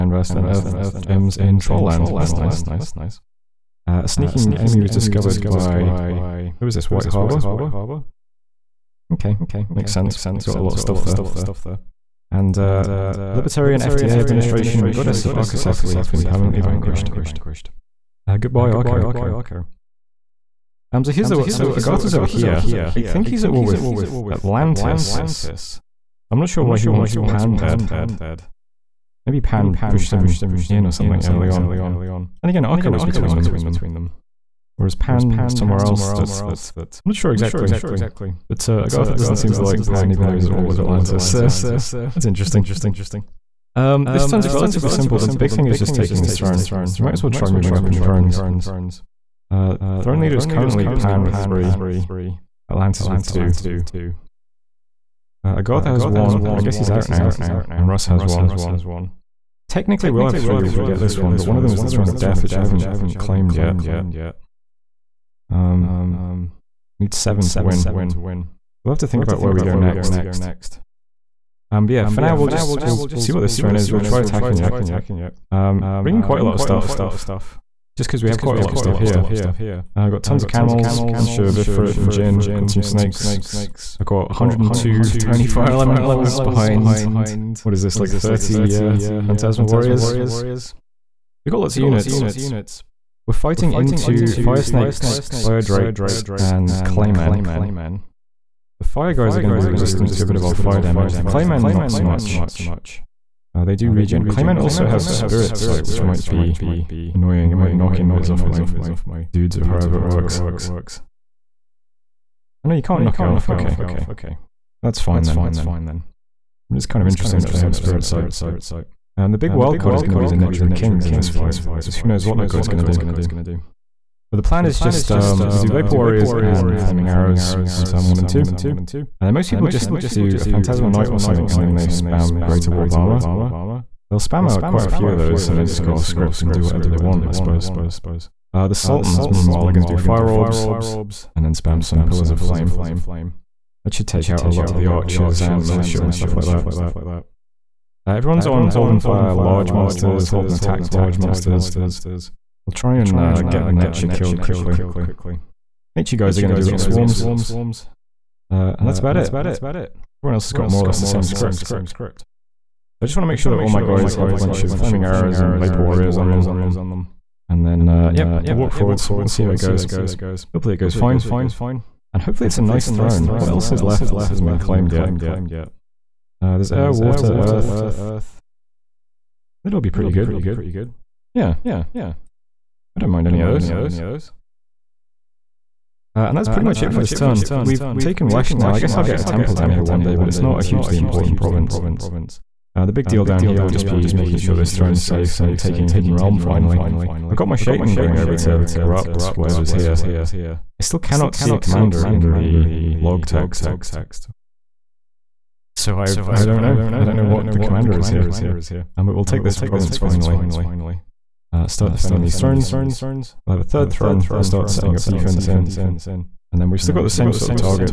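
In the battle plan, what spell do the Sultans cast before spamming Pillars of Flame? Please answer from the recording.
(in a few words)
Fire Orbs.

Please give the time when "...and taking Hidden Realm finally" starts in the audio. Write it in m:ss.
3:15.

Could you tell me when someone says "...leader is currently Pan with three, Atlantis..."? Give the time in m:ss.
0:50.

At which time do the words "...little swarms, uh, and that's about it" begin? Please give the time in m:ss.
2:36.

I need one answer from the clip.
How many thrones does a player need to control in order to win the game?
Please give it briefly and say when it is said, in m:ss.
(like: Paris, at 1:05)
7, at 1:07.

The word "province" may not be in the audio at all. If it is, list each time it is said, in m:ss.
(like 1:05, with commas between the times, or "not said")
3:11, 3:29.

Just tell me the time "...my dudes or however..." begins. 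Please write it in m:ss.
1:48.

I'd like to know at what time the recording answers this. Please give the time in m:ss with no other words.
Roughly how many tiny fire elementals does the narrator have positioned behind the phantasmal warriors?
1:24.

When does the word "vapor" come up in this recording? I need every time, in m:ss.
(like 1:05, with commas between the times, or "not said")
2:05, 2:45.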